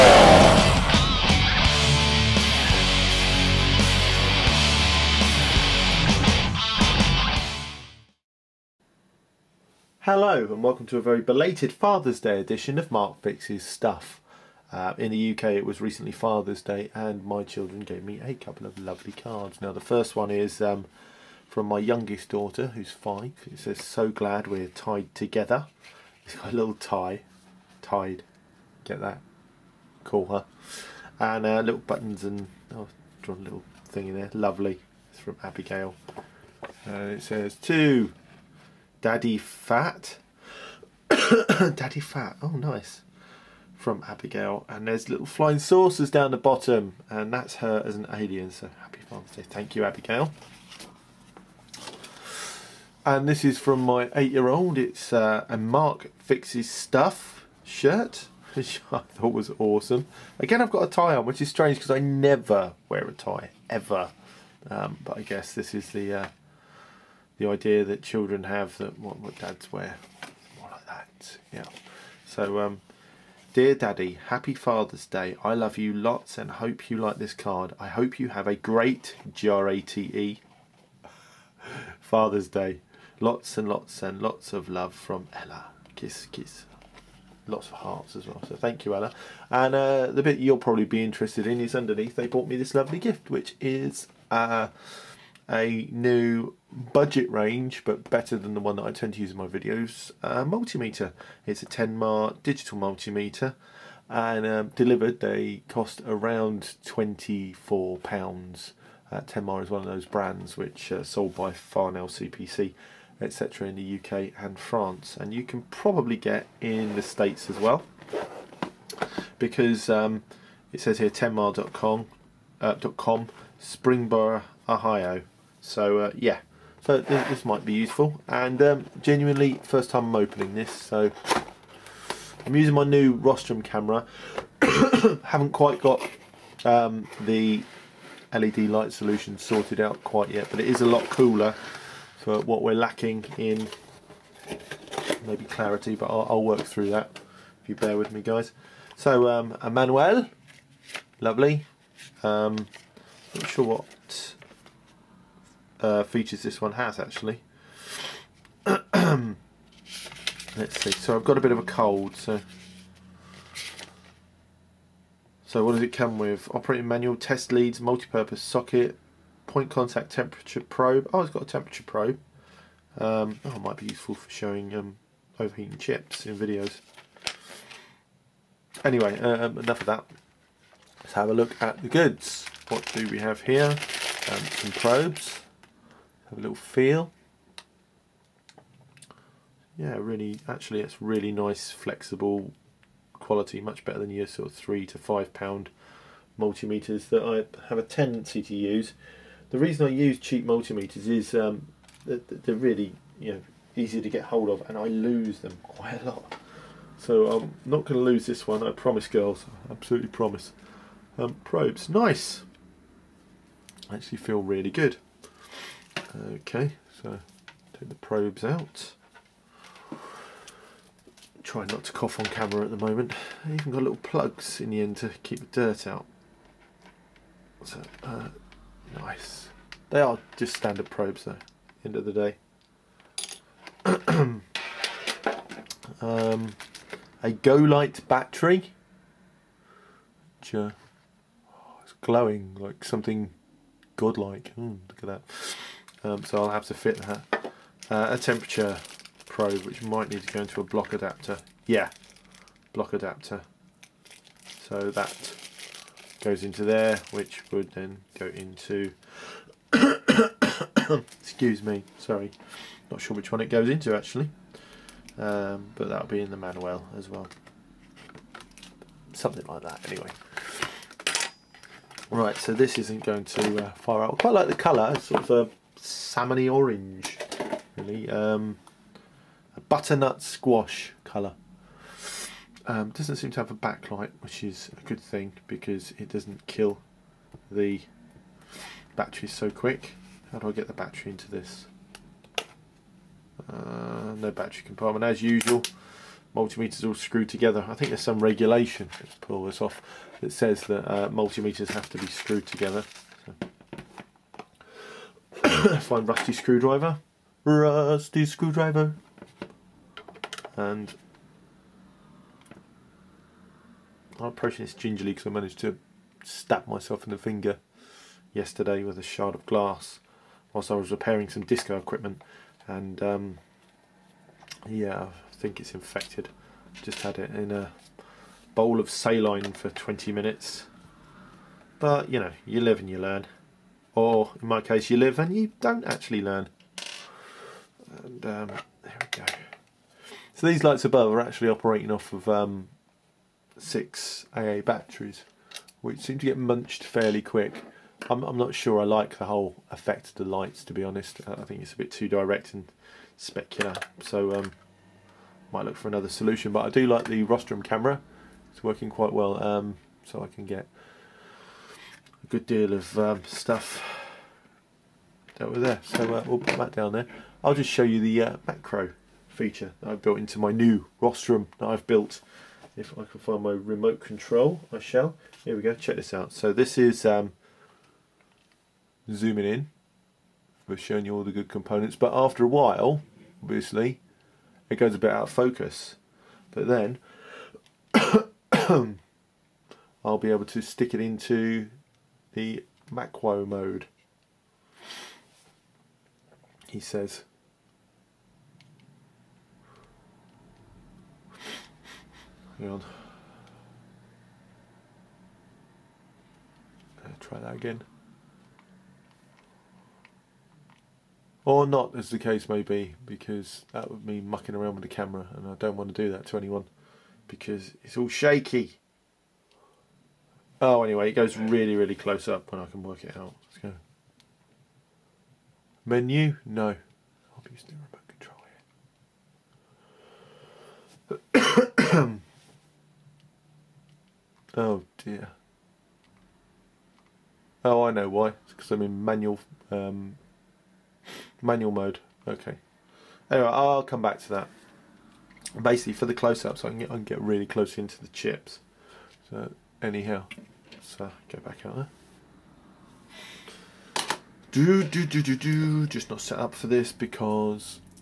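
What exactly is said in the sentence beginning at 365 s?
So uh, we'll put that down there.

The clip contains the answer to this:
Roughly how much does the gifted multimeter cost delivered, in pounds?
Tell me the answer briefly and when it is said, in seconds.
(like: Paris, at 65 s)
24 pounds, at 106 s.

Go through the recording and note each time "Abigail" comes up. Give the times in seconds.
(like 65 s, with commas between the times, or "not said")
35 s, 44 s, 49 s.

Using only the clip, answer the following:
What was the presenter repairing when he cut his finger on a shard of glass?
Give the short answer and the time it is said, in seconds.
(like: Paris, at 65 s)
Disco equipment, at 321 s.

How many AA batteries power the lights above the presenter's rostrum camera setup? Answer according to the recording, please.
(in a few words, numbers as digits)
6.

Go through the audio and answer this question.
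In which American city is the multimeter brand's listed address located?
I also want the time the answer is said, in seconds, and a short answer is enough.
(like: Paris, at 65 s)
Springboro, Ohio, at 123 s.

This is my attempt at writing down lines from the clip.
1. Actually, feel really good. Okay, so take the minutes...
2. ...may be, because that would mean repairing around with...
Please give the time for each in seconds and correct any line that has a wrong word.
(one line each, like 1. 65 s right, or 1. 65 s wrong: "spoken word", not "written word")
1. 213 s wrong: "probes", not "minutes"
2. 412 s wrong: "mucking", not "repairing".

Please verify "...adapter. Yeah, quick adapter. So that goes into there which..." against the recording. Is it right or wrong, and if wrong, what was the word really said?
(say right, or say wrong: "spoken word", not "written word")
wrong: "block", not "quick".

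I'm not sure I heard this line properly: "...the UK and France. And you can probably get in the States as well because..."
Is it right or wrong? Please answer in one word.
right.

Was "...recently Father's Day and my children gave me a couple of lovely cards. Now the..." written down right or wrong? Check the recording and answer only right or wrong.
right.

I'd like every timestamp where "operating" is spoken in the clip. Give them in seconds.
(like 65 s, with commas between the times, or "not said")
166 s, 341 s.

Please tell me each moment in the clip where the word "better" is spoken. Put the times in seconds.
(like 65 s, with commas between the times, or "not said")
98 s, 193 s.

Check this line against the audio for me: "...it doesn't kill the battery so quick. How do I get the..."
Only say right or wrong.
right.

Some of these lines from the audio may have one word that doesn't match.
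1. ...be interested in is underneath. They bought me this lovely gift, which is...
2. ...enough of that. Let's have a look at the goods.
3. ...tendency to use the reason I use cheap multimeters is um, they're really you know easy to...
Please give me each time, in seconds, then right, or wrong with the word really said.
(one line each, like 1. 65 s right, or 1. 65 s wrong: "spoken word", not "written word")
1. 90 s right
2. 179 s right
3. 197 s right.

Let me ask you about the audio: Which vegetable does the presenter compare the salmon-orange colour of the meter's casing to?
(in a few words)
Butternut squash.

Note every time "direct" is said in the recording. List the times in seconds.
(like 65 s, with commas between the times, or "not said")
352 s.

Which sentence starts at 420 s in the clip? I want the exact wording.
Oh, anyway, it goes really, really close up when I can work it out.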